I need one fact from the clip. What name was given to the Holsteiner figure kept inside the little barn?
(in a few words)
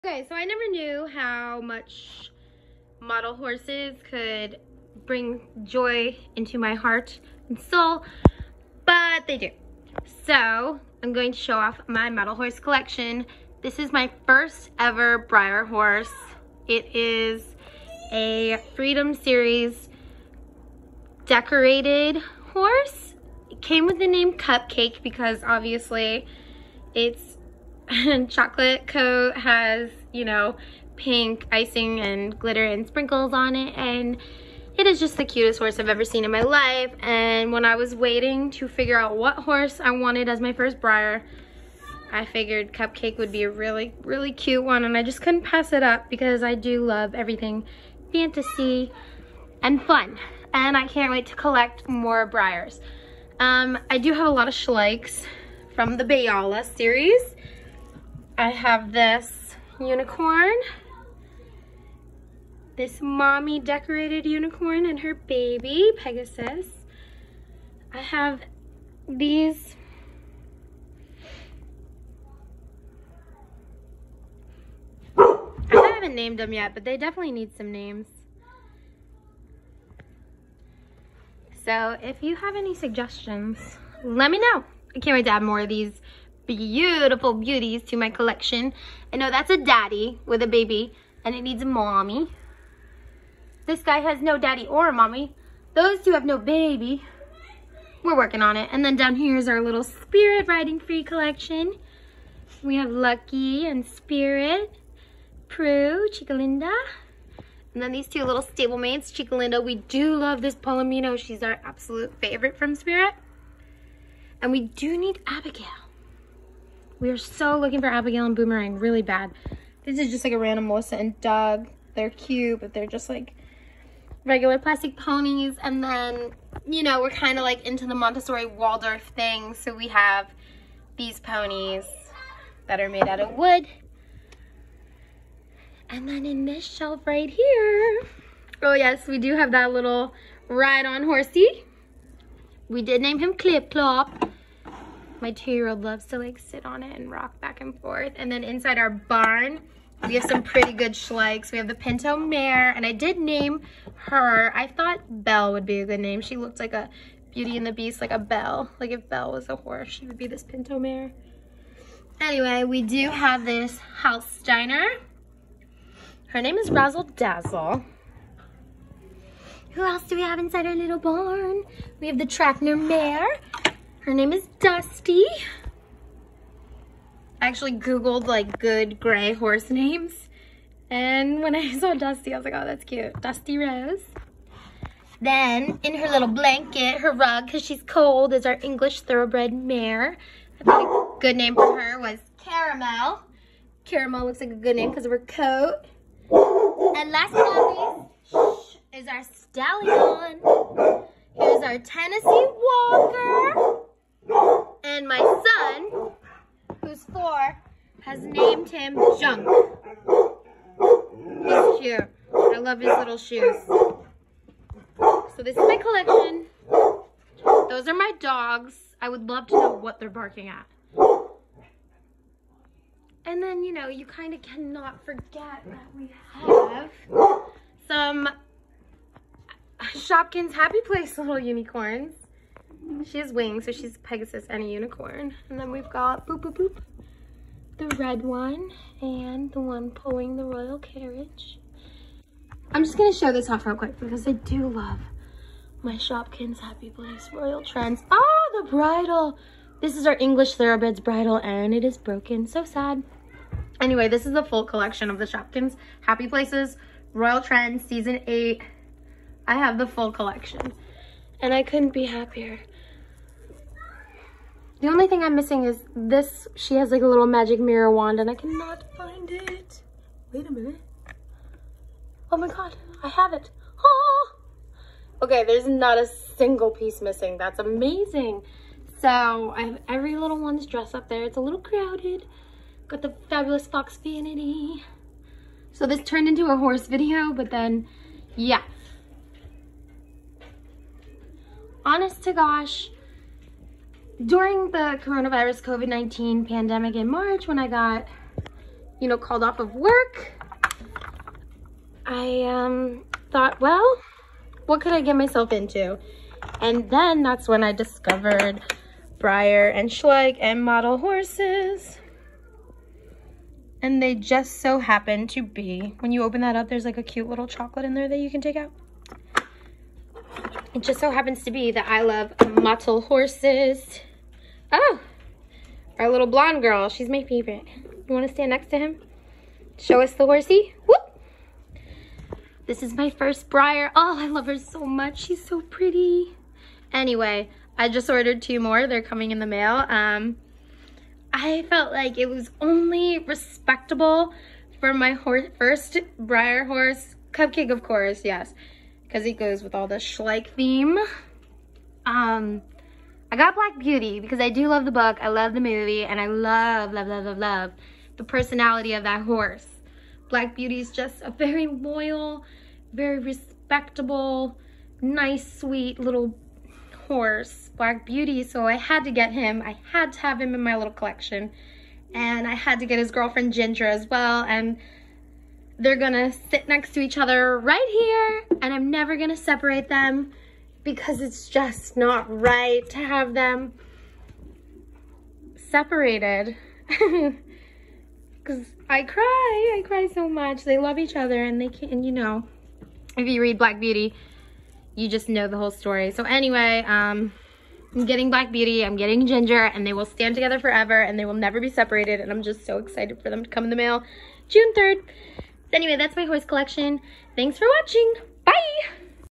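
Razzle Dazzle.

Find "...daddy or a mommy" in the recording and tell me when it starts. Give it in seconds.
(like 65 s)
94 s.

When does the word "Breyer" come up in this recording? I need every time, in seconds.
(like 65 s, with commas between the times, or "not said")
15 s, 40 s, 52 s, 309 s, 333 s, 346 s.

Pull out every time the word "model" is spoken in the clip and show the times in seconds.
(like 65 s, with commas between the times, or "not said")
2 s, 12 s, 310 s, 322 s.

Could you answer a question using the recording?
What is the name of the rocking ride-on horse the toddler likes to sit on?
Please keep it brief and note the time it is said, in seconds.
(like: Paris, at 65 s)
Clip Clop, at 143 s.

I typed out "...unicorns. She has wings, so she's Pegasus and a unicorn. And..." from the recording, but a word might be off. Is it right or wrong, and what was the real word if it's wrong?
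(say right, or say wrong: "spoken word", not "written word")
right.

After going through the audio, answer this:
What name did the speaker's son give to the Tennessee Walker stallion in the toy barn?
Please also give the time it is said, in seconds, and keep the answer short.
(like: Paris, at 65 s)
Junk, at 209 s.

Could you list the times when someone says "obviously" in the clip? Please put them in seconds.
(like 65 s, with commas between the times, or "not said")
25 s.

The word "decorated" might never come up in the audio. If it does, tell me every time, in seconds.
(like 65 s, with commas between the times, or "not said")
21 s, 63 s.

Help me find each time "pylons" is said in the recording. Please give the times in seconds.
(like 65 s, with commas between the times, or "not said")
not said.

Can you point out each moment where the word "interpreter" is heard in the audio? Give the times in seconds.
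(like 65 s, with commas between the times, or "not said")
not said.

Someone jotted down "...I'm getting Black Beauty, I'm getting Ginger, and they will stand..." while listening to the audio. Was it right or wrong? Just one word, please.
right.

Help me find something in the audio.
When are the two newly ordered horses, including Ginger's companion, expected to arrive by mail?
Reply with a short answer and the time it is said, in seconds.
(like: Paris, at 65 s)
June 3rd, at 404 s.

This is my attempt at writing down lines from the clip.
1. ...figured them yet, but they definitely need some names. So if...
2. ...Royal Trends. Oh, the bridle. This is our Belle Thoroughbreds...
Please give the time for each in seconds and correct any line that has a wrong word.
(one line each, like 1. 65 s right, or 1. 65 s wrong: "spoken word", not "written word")
1. 76 s wrong: "named", not "figured"
2. 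247 s wrong: "English", not "Belle".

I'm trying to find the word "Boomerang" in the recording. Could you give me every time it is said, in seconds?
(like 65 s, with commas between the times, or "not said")
118 s.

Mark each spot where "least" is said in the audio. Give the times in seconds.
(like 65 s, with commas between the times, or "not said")
198 s.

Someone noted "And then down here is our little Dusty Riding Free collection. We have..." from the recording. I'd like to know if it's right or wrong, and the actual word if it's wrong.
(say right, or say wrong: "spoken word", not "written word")
wrong: "Spirit", not "Dusty".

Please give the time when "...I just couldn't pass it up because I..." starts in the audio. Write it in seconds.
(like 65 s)
44 s.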